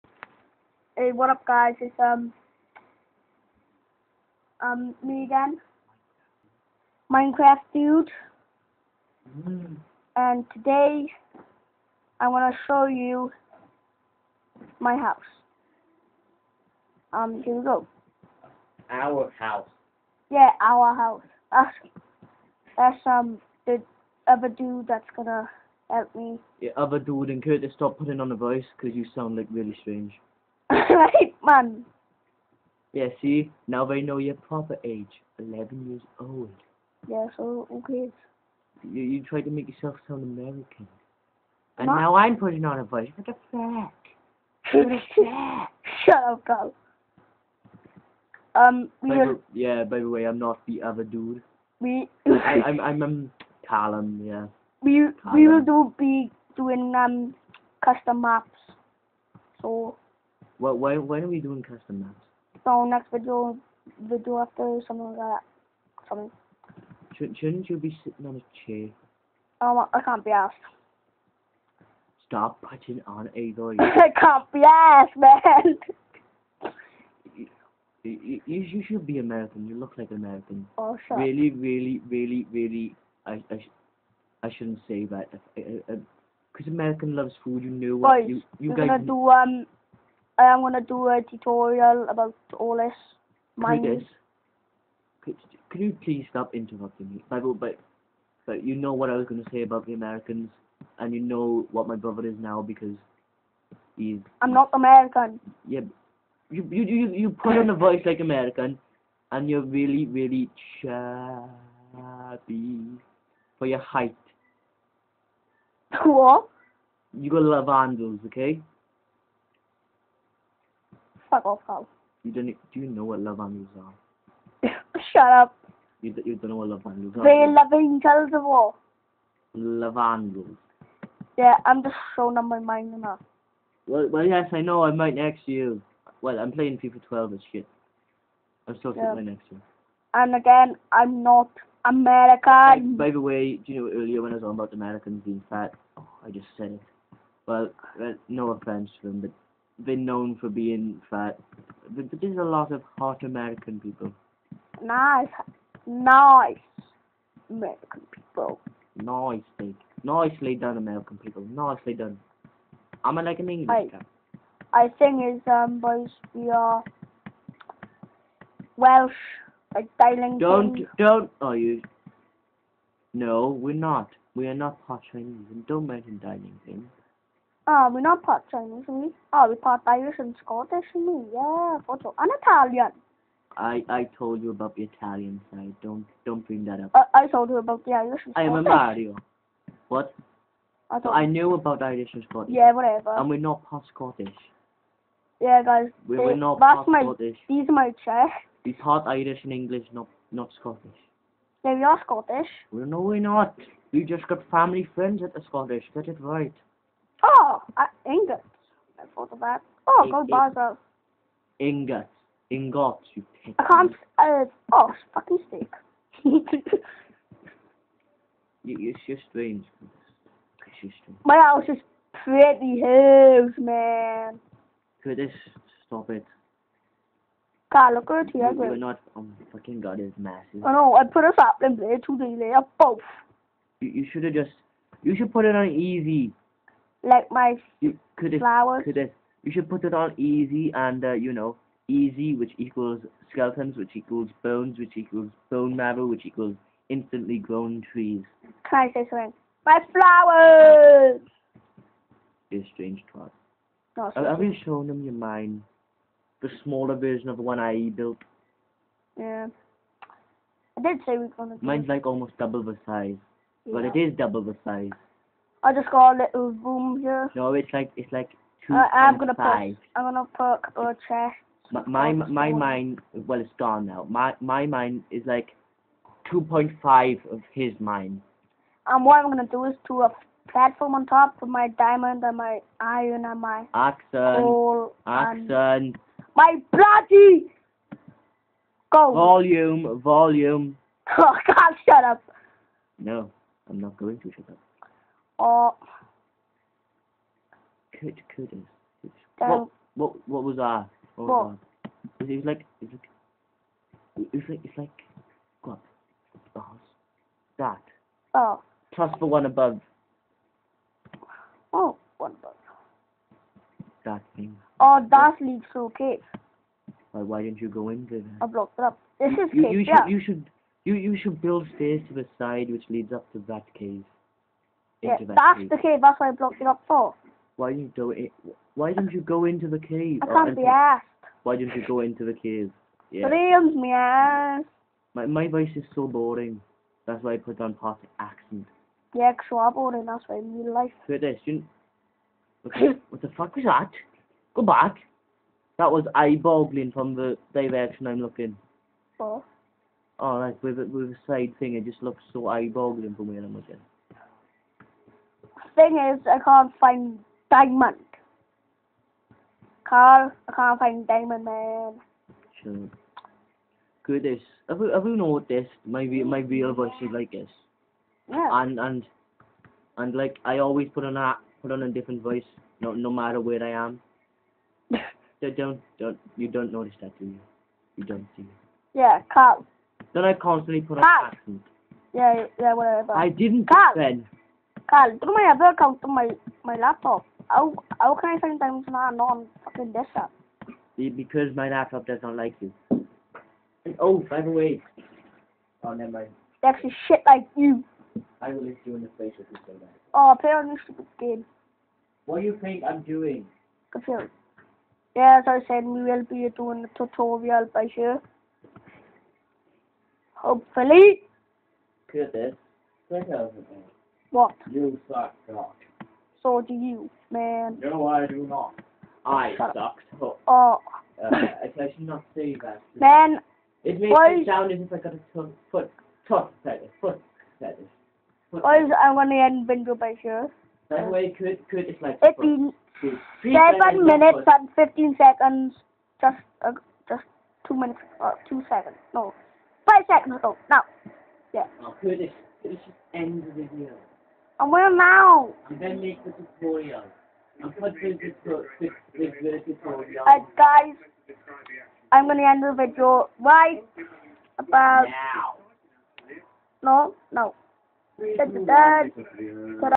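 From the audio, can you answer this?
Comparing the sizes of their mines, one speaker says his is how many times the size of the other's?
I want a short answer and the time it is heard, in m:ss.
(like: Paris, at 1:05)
2.5, at 4:36.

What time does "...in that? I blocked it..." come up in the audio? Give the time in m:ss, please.
5:17.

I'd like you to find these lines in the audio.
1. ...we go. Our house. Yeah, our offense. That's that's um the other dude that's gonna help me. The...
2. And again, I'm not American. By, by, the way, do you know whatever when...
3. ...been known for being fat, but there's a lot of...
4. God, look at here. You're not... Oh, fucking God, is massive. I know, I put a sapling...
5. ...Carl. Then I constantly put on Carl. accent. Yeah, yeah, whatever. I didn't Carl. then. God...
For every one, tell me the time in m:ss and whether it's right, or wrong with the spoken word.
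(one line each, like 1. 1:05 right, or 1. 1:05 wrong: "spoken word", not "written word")
1. 0:17 wrong: "house", not "offense"
2. 2:20 wrong: "earlier", not "whatever"
3. 2:29 right
4. 3:47 right
5. 6:19 right.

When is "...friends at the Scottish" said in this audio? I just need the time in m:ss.
3:24.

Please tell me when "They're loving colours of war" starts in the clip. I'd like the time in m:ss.
2:07.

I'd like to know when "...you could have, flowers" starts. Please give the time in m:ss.
3:57.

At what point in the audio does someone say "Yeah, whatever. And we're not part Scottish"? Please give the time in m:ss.
3:12.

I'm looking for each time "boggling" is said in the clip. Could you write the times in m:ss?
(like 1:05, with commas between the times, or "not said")
5:46, 5:52.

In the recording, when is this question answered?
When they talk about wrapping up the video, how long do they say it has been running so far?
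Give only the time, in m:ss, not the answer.
7:13.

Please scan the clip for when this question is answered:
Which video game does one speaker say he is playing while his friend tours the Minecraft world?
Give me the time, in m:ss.
2:16.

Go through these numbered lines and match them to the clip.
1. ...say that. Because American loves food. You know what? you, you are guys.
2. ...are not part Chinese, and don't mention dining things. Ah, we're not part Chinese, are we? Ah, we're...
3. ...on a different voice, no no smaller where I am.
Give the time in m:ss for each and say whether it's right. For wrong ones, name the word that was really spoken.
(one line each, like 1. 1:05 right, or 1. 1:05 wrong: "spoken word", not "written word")
1. 1:24 right
2. 2:54 right
3. 6:11 wrong: "matter", not "smaller".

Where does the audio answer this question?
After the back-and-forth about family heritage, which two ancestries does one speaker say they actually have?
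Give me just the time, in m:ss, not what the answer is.
3:19.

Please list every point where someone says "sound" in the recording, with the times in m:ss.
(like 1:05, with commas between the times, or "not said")
0:29, 0:40, 7:04.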